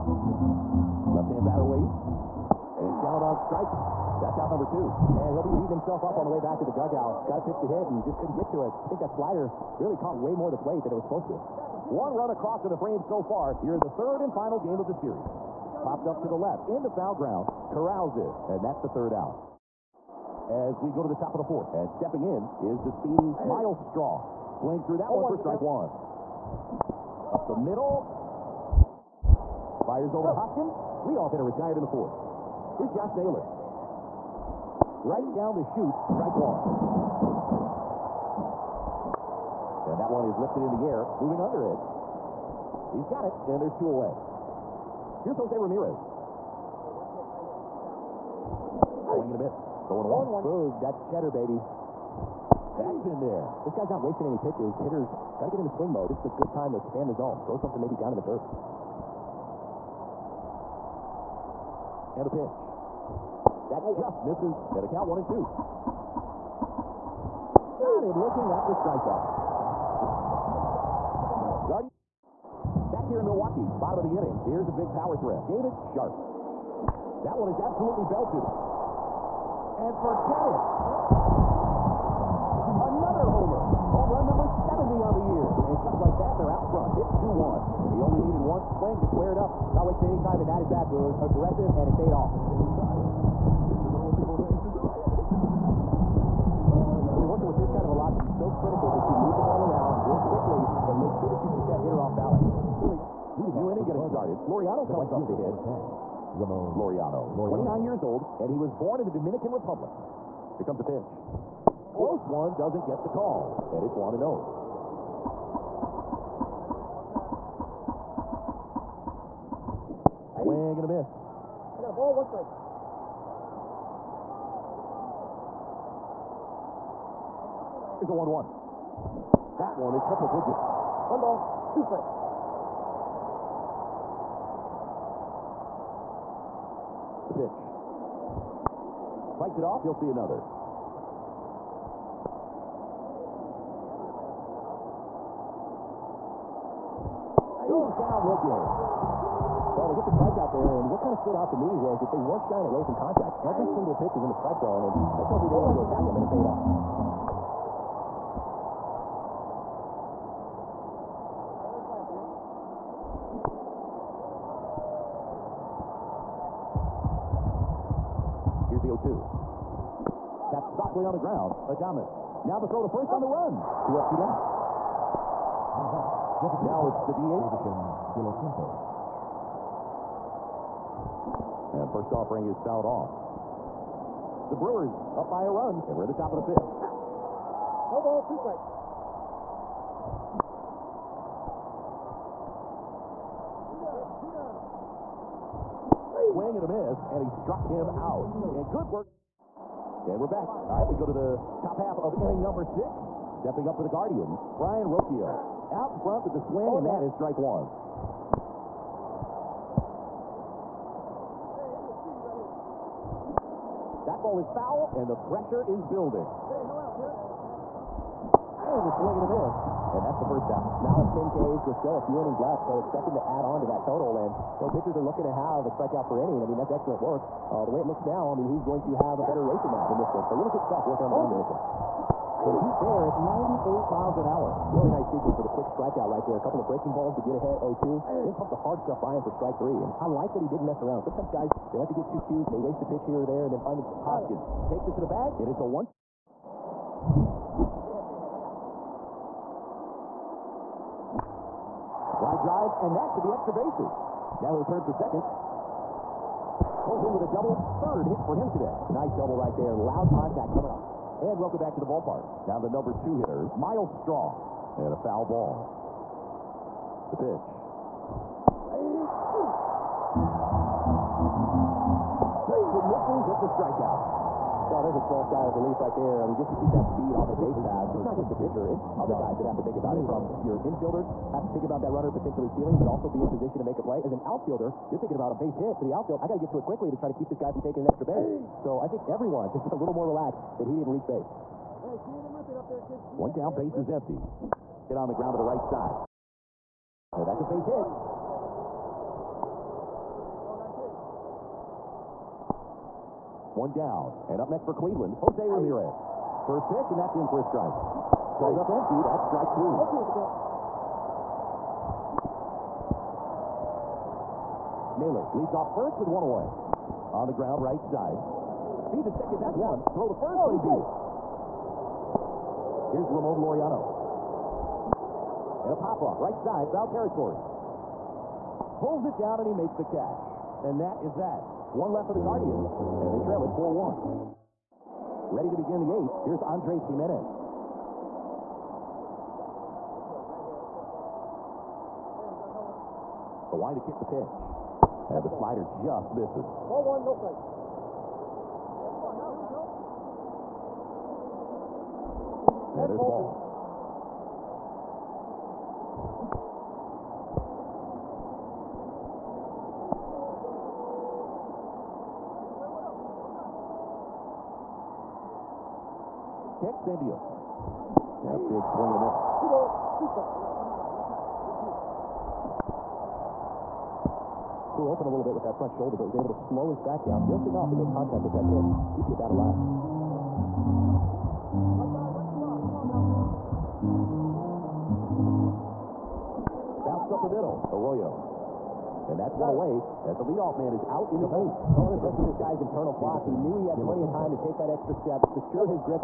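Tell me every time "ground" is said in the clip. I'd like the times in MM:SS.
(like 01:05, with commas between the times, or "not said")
00:17, 02:51, 04:55, 05:17.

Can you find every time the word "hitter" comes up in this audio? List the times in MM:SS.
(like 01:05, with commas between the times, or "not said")
00:31, 00:54, 01:41, 04:23.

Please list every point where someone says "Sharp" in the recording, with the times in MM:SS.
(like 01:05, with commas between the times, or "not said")
01:15.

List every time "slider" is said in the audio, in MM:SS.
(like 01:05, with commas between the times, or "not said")
00:09, 05:45.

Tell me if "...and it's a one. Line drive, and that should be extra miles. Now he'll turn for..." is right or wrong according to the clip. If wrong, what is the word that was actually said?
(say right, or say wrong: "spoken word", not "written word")
wrong: "bases", not "miles".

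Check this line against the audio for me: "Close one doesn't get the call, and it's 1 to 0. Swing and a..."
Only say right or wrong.
right.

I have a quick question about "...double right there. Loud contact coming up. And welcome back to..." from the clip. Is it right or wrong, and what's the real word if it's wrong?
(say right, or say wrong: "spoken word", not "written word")
right.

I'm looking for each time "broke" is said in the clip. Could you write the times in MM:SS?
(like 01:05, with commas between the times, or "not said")
not said.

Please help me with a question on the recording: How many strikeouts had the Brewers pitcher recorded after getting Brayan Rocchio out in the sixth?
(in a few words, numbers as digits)
10.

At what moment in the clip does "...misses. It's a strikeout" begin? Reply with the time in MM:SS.
04:32.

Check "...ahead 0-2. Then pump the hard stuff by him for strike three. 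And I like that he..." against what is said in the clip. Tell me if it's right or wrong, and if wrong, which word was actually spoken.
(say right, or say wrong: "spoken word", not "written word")
right.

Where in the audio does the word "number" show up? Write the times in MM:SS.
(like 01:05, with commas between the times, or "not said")
00:04, 03:22, 04:22.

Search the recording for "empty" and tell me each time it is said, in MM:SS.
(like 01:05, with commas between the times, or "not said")
04:53, 05:08.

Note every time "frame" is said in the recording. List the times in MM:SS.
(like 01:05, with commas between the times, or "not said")
00:12.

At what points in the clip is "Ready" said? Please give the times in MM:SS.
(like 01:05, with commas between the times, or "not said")
05:35.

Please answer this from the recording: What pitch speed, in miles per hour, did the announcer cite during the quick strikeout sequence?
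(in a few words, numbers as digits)
98.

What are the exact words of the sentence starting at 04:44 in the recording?
As an outfielder, you're thinking about a base hit to the outfield.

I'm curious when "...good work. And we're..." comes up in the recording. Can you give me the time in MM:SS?
03:18.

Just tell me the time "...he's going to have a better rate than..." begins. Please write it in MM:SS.
03:48.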